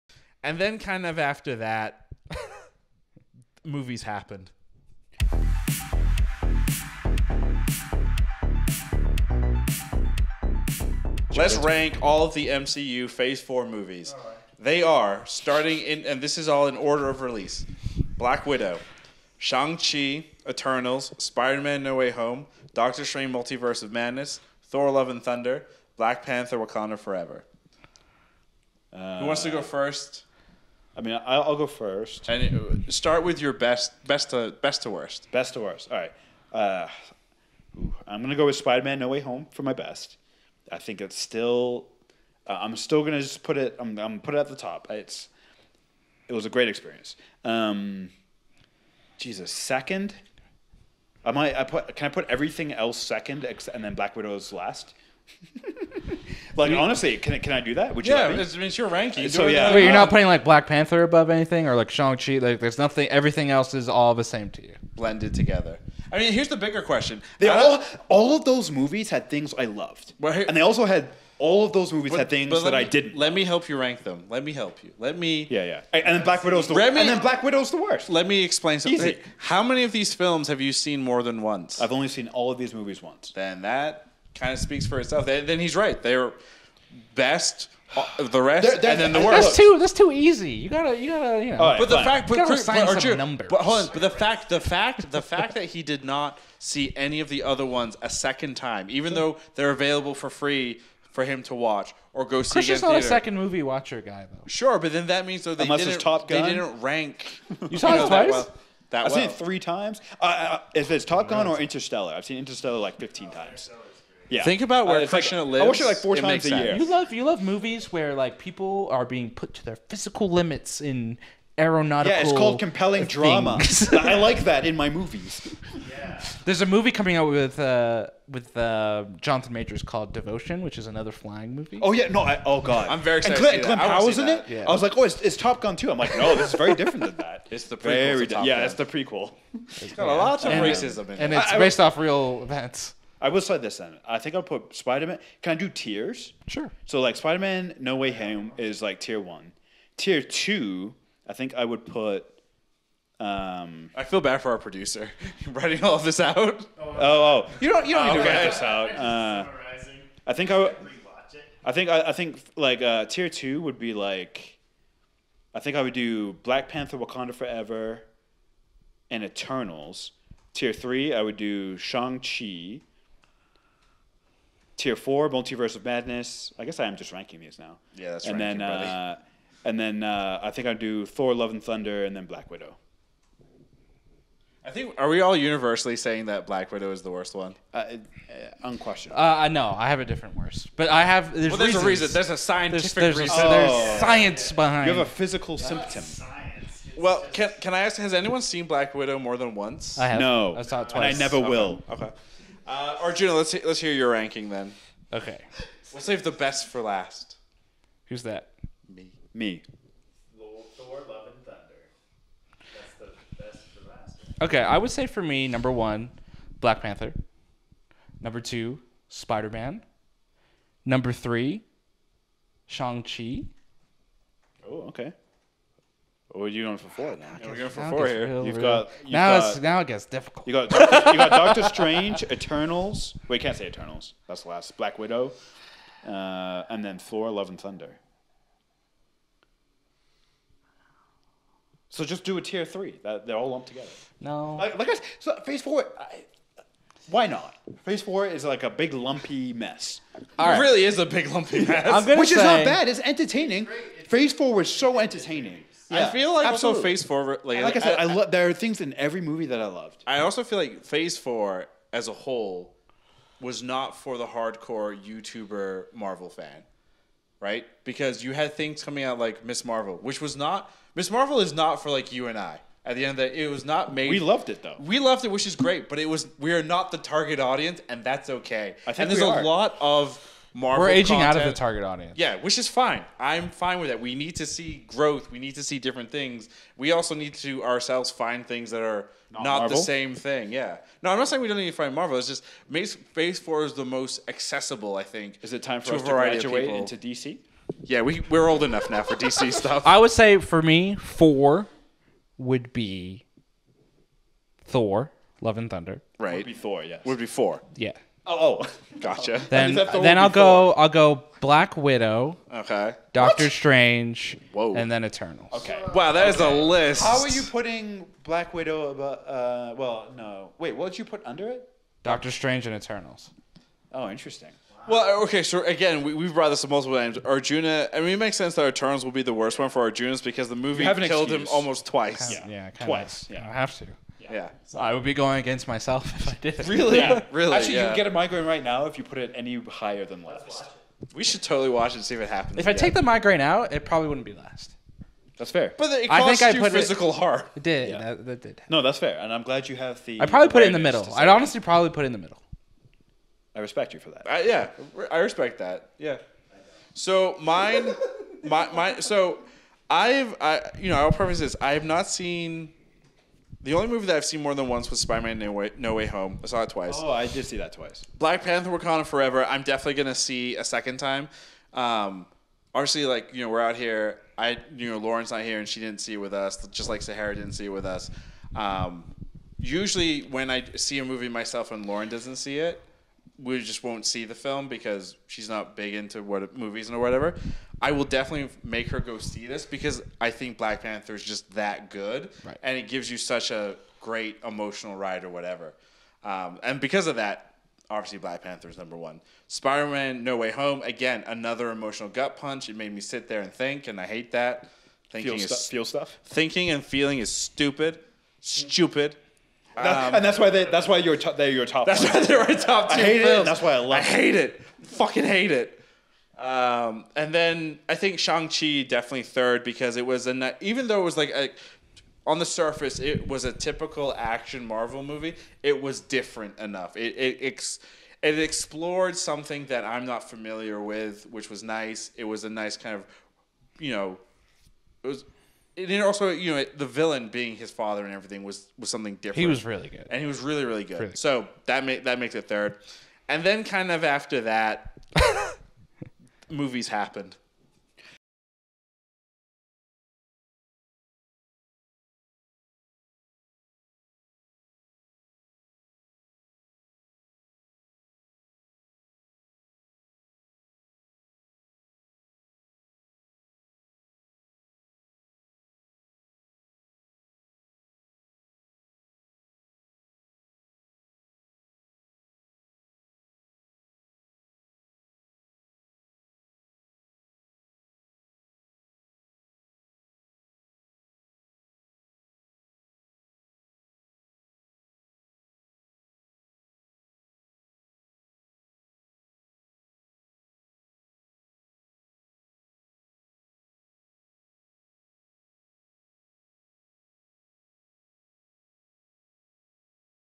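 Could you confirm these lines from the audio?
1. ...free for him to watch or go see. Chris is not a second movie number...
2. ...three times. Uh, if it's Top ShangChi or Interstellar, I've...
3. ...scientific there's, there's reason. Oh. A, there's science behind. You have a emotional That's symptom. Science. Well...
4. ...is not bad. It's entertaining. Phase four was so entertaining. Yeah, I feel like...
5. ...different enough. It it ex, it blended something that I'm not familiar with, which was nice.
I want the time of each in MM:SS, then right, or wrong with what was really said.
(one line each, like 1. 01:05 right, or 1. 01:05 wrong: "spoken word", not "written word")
1. 01:40 wrong: "watcher", not "number"
2. 01:49 wrong: "Gun", not "ShangChi"
3. 03:12 wrong: "physical", not "emotional"
4. 04:12 right
5. 07:06 wrong: "explored", not "blended".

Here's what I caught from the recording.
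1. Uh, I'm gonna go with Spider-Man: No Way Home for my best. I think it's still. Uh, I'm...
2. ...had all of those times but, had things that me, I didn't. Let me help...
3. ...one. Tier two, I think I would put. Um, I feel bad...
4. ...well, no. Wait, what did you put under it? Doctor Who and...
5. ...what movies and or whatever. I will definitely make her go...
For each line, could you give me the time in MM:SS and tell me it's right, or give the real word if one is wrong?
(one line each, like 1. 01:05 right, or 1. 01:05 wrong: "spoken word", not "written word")
1. 00:36 right
2. 01:10 wrong: "movies", not "times"
3. 02:29 right
4. 05:19 wrong: "Strange", not "Who"
5. 06:26 right.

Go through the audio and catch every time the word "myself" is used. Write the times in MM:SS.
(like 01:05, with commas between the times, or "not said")
05:35, 06:21.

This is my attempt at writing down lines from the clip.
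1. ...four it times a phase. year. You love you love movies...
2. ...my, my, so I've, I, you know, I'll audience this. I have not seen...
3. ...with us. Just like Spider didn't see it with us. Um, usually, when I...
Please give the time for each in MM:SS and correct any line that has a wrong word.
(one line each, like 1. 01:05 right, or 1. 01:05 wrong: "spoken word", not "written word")
1. 01:55 wrong: "sense", not "phase"
2. 05:58 wrong: "preface", not "audience"
3. 06:16 wrong: "Sahara", not "Spider".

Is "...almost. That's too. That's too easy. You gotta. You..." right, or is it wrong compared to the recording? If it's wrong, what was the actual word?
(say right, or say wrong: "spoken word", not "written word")
wrong: "worst", not "almost".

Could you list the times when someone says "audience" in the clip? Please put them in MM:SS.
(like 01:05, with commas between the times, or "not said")
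04:37, 04:41.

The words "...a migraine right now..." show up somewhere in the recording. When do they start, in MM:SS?
05:38.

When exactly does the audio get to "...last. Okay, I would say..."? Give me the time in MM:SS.
03:33.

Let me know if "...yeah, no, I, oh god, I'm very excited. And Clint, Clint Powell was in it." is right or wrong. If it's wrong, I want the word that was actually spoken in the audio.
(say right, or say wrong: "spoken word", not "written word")
right.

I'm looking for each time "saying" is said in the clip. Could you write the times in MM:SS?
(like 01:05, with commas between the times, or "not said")
03:05, 04:51.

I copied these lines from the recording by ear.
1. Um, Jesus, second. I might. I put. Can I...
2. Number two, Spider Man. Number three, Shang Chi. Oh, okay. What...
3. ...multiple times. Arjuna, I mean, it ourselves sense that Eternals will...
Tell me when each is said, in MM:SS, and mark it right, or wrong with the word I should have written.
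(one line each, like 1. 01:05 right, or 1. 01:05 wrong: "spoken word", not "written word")
1. 00:47 right
2. 03:38 right
3. 05:26 wrong: "makes", not "ourselves".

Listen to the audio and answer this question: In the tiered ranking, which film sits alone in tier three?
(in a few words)
Shang-Chi.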